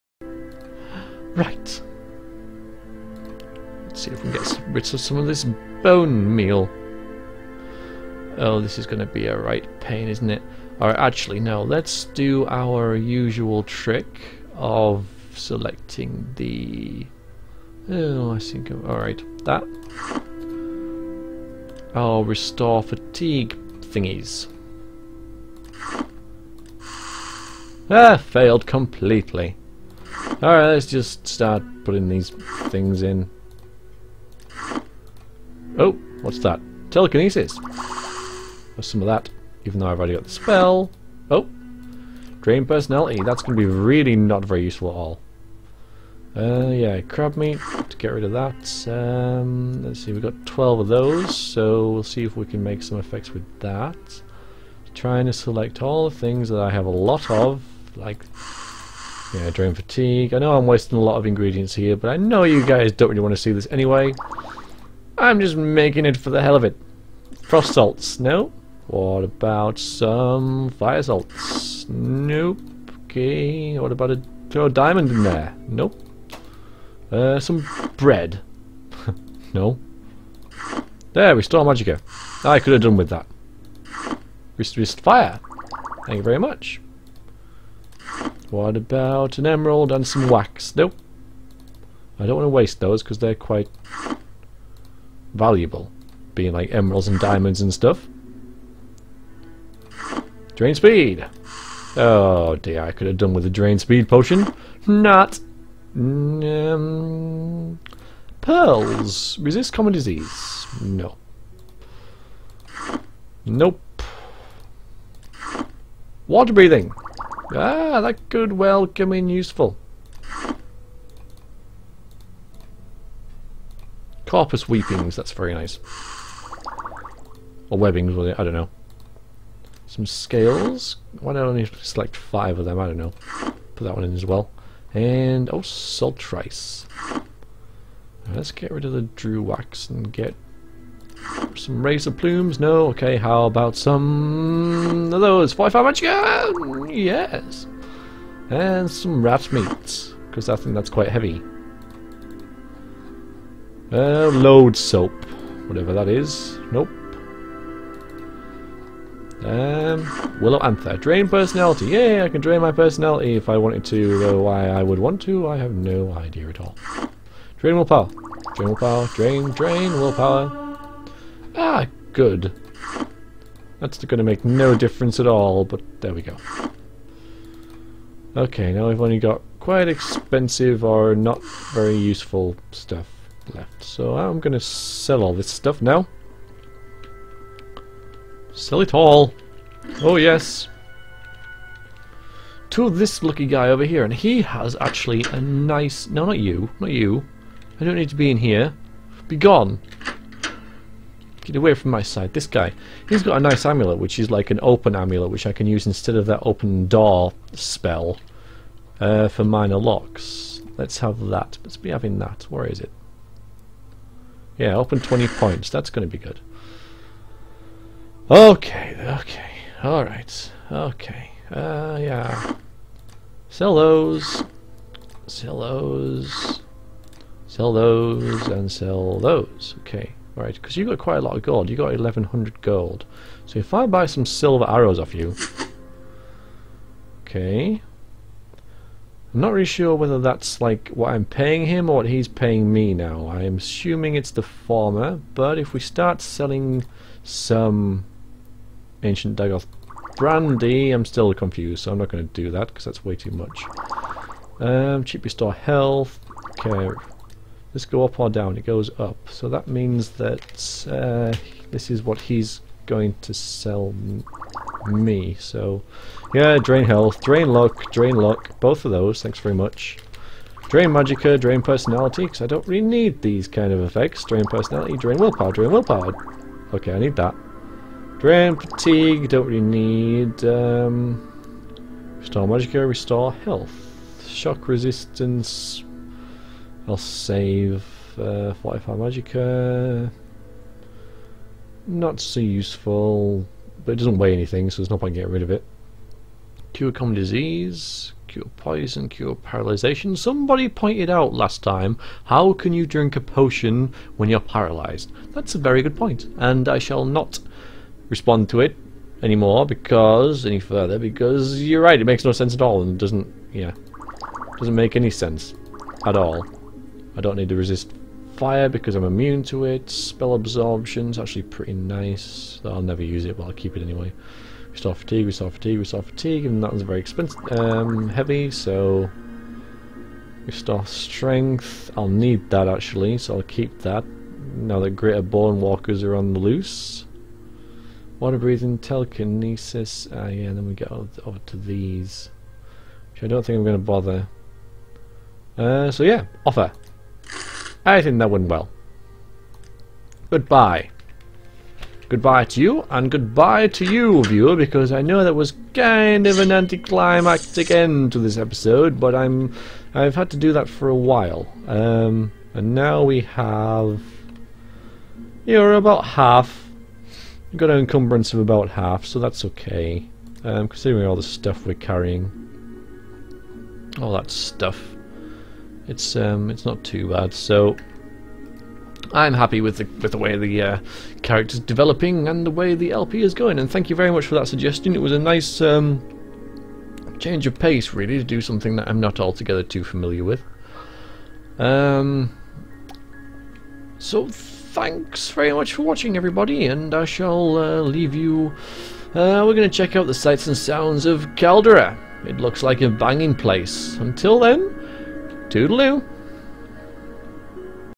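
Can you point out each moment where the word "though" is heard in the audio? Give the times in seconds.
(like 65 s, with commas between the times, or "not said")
39 s, 164 s.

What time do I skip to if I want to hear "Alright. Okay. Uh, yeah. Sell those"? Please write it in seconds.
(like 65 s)
219 s.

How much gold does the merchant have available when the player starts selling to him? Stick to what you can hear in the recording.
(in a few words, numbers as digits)
1100 gold.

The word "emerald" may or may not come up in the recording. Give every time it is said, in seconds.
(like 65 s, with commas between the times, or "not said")
89 s, 96 s.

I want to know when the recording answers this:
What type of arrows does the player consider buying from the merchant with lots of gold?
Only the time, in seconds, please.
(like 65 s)
234 s.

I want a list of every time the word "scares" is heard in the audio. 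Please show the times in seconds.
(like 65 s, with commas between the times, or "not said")
not said.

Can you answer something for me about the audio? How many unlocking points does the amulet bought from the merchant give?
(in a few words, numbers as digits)
20.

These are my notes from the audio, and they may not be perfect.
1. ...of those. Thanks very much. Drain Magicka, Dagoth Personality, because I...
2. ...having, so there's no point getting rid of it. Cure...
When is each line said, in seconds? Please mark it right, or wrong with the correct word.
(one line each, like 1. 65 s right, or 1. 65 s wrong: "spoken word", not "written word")
1. 268 s wrong: "Drain", not "Dagoth"
2. 294 s wrong: "anything", not "having".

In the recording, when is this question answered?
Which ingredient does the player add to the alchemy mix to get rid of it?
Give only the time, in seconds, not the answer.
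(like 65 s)
47 s.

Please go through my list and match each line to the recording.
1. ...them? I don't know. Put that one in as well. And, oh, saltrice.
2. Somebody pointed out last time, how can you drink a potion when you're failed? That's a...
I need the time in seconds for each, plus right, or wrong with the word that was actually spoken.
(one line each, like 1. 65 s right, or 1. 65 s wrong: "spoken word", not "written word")
1. 132 s right
2. 300 s wrong: "paralyzed", not "failed".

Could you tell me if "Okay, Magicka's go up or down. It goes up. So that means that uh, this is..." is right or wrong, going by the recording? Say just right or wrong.
wrong.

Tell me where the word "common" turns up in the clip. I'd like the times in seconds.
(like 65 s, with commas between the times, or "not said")
109 s, 296 s.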